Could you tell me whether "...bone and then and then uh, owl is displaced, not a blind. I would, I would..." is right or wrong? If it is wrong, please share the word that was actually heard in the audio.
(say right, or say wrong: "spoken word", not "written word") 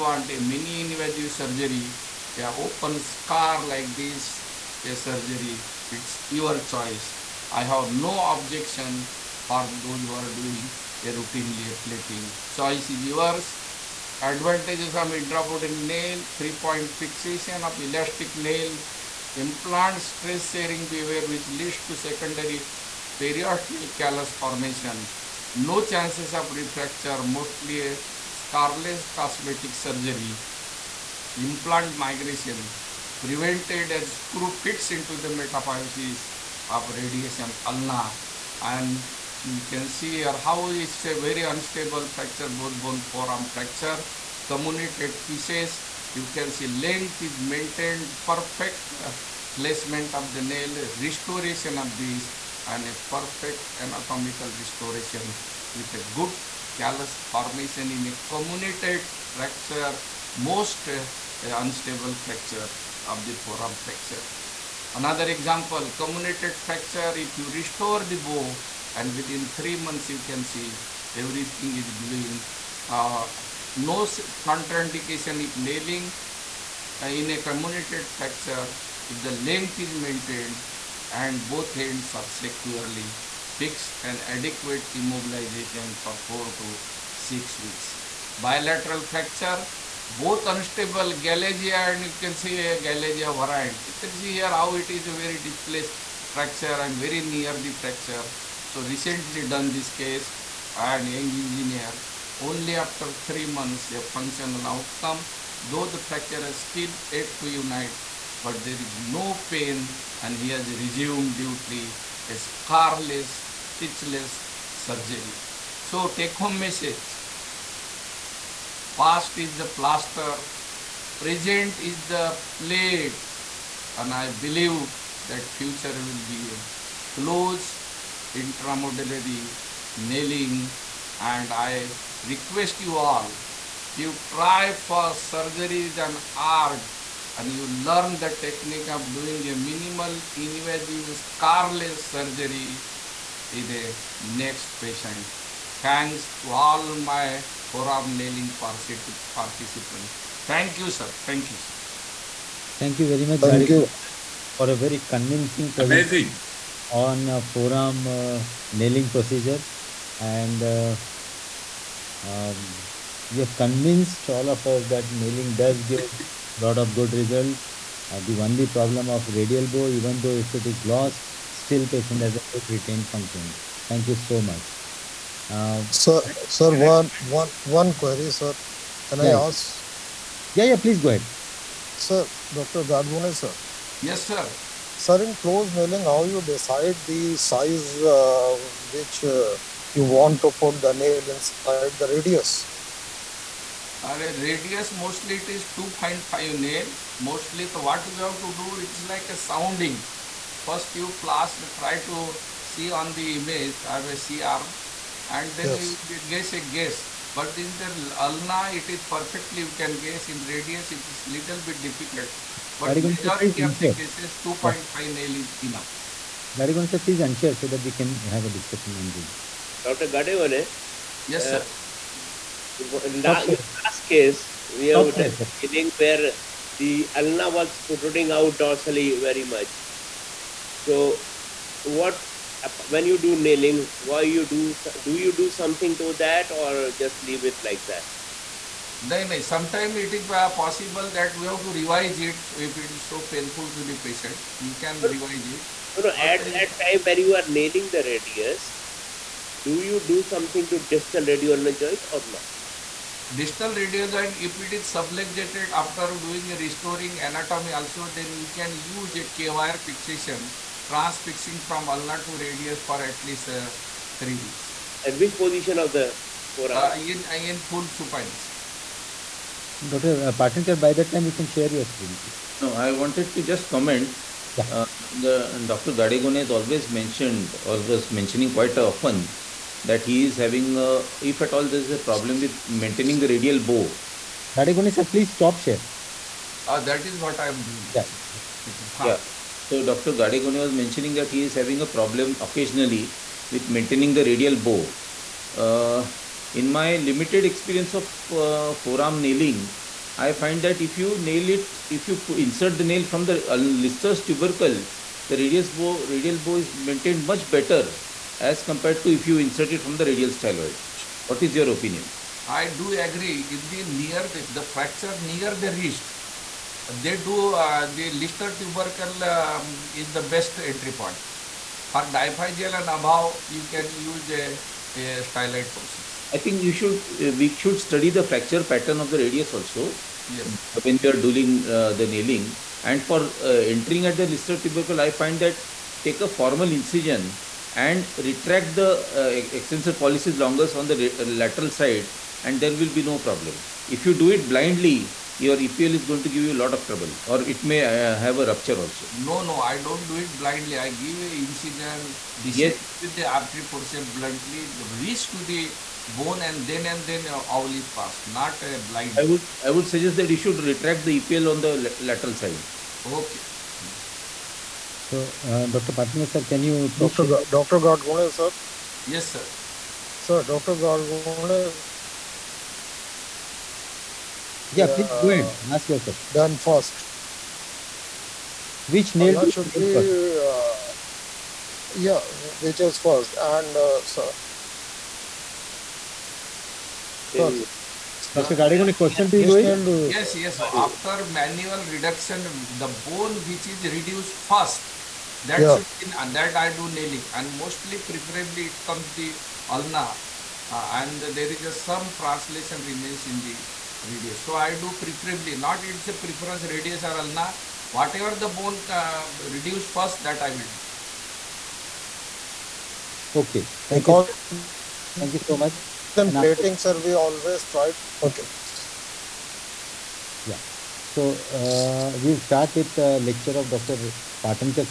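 wrong: "passed", not "displaced".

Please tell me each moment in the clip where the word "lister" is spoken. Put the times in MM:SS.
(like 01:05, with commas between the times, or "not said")
05:03, 05:18, 05:34.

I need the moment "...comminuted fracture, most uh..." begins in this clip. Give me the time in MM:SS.
00:58.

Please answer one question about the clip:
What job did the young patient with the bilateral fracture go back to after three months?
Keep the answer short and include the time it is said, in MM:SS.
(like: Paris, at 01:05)
Engineer, at 01:41.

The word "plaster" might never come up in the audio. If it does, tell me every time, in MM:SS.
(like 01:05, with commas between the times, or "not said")
01:59, 03:21.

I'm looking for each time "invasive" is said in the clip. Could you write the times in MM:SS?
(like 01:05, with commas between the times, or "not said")
00:00, 02:20.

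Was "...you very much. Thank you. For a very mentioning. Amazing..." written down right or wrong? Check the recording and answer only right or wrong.
wrong.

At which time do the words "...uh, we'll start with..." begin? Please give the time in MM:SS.
07:01.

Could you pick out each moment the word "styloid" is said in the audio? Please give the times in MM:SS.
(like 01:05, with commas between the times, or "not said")
05:10, 05:25.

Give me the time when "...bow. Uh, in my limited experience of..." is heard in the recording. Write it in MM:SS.
04:54.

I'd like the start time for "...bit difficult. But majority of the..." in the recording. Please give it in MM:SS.
03:31.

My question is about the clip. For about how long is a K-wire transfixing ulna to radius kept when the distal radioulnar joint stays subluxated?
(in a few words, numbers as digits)
3 weeks.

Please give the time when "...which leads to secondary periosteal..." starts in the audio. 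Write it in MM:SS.
00:21.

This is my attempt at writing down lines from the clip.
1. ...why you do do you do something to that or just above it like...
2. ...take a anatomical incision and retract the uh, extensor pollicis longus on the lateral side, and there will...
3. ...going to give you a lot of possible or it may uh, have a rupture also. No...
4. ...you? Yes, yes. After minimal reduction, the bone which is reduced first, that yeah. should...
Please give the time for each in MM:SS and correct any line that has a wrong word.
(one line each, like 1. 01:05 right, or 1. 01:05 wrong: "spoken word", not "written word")
1. 03:53 wrong: "leave", not "above"
2. 05:36 wrong: "formal", not "anatomical"
3. 05:46 wrong: "trouble", not "possible"
4. 06:29 wrong: "manual", not "minimal".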